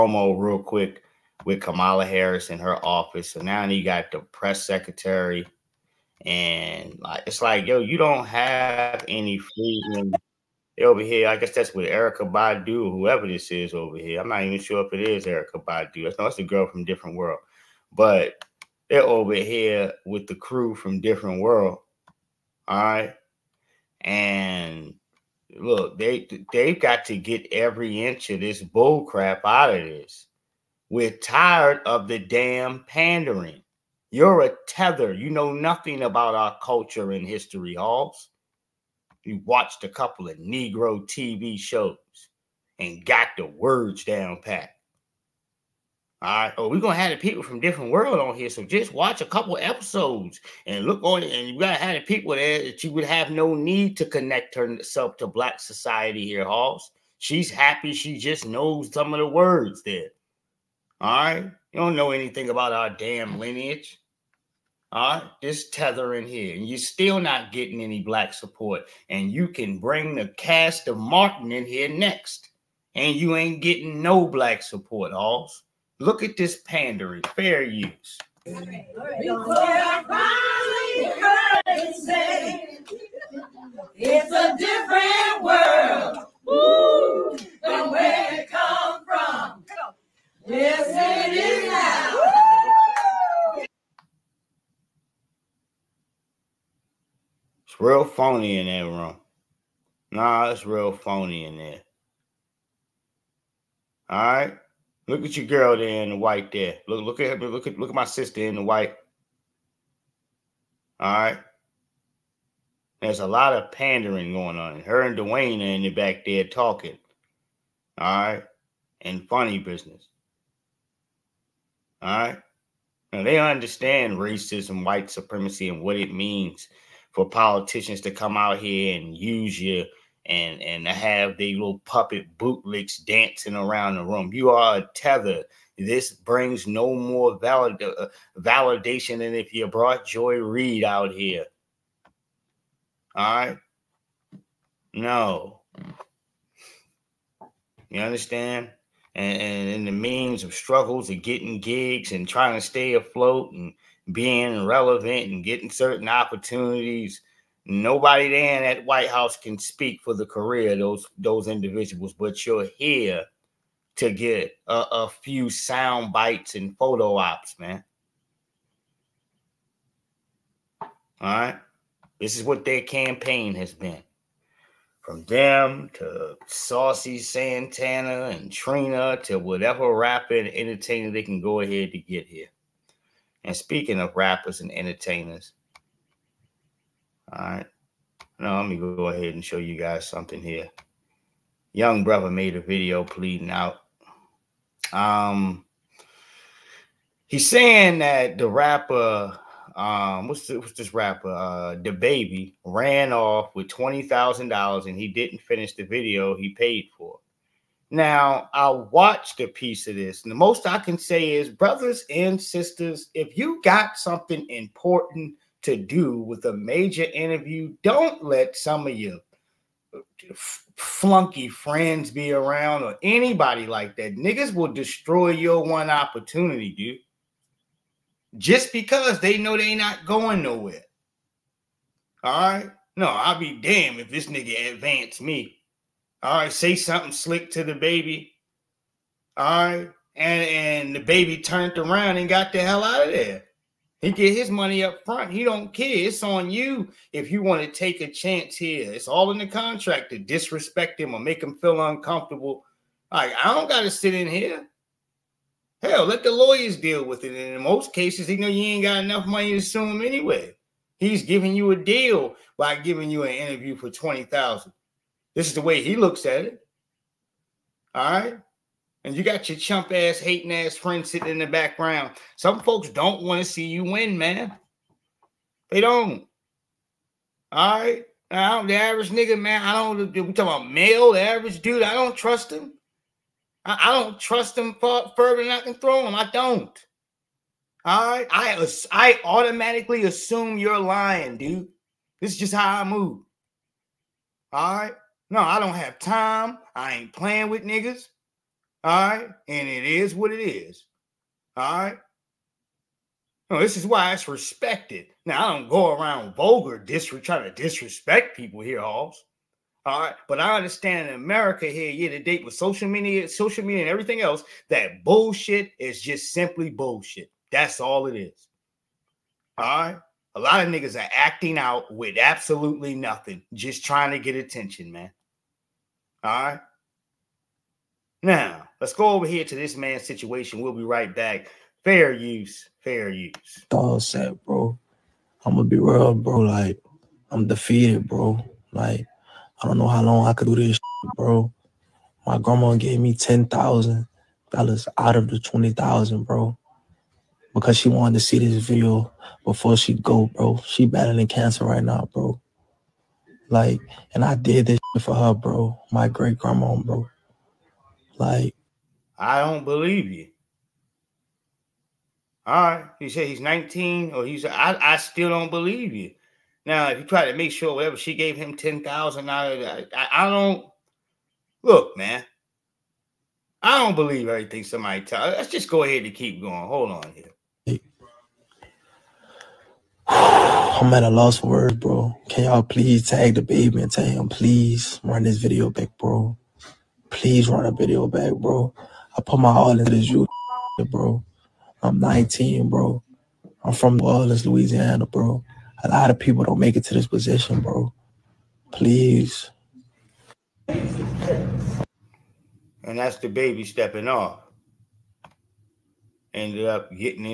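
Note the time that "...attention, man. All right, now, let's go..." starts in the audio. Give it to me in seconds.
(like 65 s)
324 s.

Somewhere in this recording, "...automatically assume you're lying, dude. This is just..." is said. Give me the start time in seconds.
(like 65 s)
289 s.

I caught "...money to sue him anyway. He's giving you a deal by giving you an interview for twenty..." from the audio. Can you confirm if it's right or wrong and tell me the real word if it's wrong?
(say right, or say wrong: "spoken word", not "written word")
right.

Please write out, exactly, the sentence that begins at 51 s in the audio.
And you gotta have the people there that you would have no need to connect herself to black society here, Halls.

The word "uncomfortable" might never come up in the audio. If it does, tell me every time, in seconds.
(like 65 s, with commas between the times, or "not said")
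251 s.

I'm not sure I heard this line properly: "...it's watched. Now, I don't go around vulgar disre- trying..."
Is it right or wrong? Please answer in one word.
wrong.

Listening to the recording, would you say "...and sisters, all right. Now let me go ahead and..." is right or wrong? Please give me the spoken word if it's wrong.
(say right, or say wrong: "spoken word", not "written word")
wrong: "entertainers", not "sisters".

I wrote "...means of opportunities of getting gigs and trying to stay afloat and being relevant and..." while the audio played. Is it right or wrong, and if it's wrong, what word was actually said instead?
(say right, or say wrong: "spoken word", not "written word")
wrong: "struggles", not "opportunities".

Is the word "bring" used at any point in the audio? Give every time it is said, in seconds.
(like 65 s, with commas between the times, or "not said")
69 s, 136 s.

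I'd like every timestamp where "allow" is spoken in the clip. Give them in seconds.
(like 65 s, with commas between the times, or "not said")
not said.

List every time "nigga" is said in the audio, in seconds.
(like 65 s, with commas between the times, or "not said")
224 s, 234 s, 279 s, 297 s, 320 s.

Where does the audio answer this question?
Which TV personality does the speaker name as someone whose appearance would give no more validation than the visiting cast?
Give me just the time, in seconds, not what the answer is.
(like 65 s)
140 s.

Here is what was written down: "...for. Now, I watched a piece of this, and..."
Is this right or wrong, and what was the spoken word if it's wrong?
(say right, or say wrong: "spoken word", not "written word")
right.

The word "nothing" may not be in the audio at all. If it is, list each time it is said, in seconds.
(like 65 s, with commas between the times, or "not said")
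35 s, 322 s.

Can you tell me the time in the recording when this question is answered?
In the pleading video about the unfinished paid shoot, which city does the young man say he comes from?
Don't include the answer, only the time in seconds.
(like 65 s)
393 s.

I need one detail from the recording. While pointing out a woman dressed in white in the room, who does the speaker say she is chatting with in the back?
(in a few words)
Dwayne.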